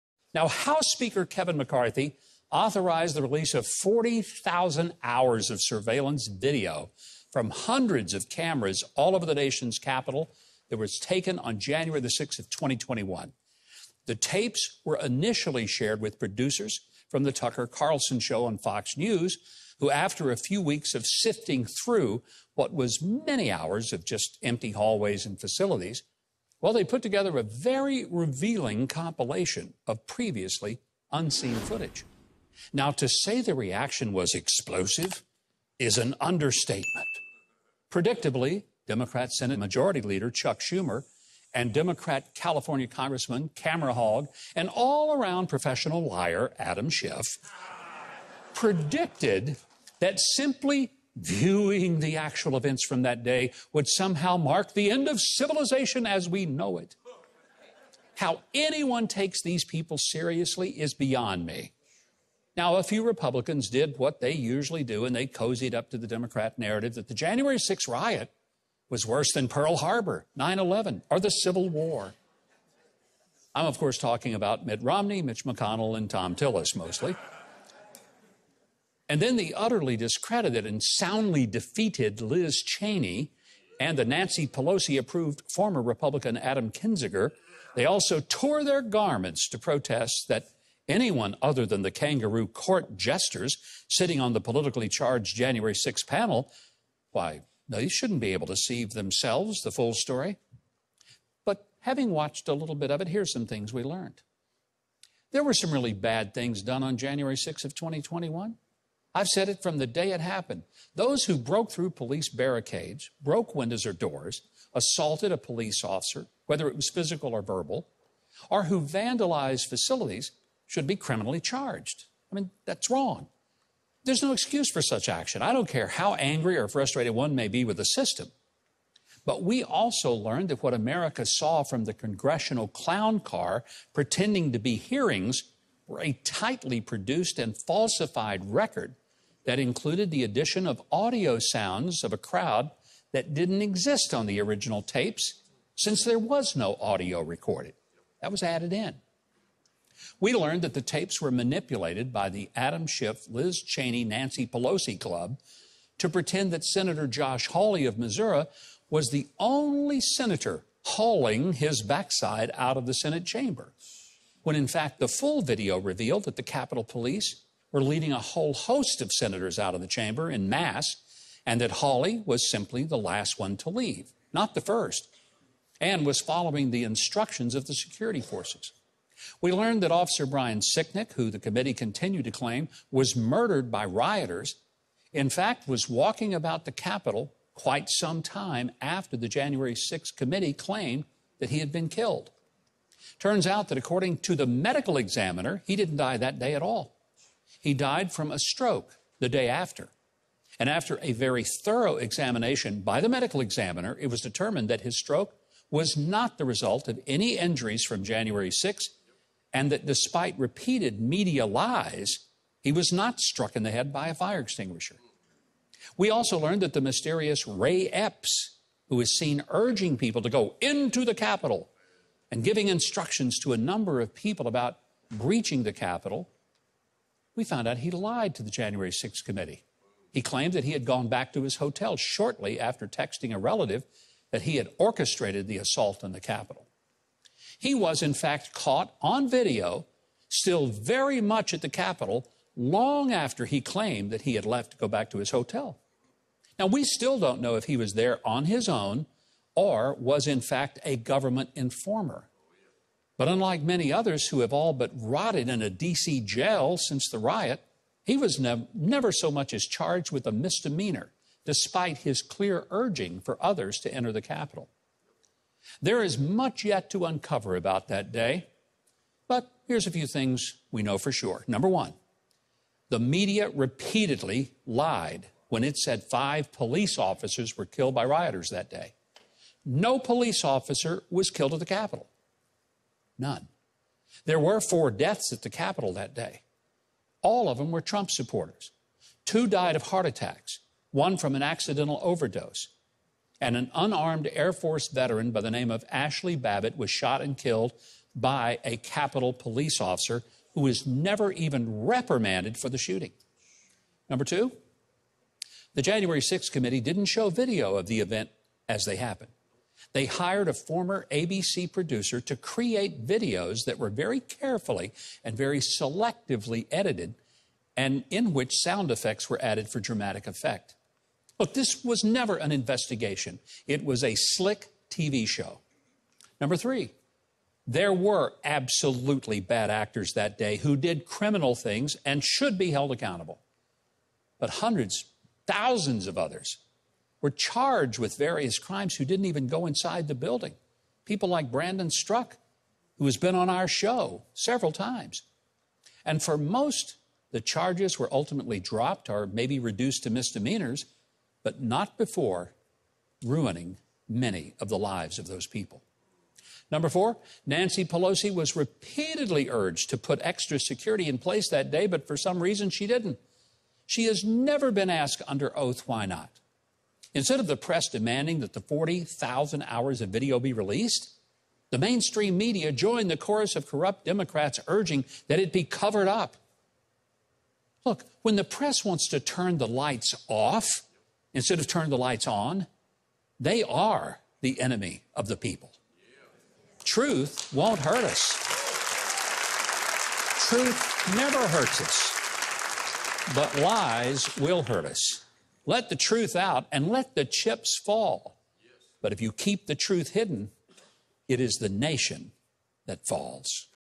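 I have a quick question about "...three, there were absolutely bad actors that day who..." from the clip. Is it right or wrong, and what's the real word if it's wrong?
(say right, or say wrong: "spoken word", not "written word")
right.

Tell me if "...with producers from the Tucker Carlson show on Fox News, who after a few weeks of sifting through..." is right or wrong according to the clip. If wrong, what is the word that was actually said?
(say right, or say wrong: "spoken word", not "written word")
right.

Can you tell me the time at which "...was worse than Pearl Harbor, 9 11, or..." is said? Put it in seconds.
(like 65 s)
68 s.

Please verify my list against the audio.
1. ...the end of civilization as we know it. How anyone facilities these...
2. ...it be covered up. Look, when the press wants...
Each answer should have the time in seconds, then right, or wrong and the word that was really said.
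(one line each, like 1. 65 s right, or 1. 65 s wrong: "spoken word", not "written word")
1. 54 s wrong: "takes", not "facilities"
2. 375 s right.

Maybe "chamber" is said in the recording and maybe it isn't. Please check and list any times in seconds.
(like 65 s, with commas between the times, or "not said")
163 s, 169 s.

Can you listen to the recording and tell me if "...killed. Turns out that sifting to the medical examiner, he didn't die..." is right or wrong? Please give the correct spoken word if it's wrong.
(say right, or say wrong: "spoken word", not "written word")
wrong: "according", not "sifting".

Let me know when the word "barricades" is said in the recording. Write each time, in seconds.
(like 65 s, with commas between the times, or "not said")
112 s.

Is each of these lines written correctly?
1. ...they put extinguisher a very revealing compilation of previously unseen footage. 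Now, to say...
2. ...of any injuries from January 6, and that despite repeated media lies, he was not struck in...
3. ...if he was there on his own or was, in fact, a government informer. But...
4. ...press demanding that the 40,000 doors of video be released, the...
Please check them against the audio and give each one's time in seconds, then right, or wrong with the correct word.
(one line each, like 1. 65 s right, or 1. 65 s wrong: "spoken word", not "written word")
1. 26 s wrong: "together", not "extinguisher"
2. 206 s right
3. 247 s right
4. 367 s wrong: "hours", not "doors".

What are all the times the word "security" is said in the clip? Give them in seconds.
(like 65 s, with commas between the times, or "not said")
177 s, 360 s.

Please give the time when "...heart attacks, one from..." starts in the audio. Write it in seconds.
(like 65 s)
289 s.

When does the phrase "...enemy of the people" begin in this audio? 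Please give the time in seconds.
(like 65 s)
384 s.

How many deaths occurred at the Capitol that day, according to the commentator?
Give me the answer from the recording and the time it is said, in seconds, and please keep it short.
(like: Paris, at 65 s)
4, at 284 s.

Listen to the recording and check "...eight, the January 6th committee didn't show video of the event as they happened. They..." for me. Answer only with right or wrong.
wrong.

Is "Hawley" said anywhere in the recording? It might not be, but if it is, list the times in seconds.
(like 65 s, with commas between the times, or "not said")
157 s, 171 s.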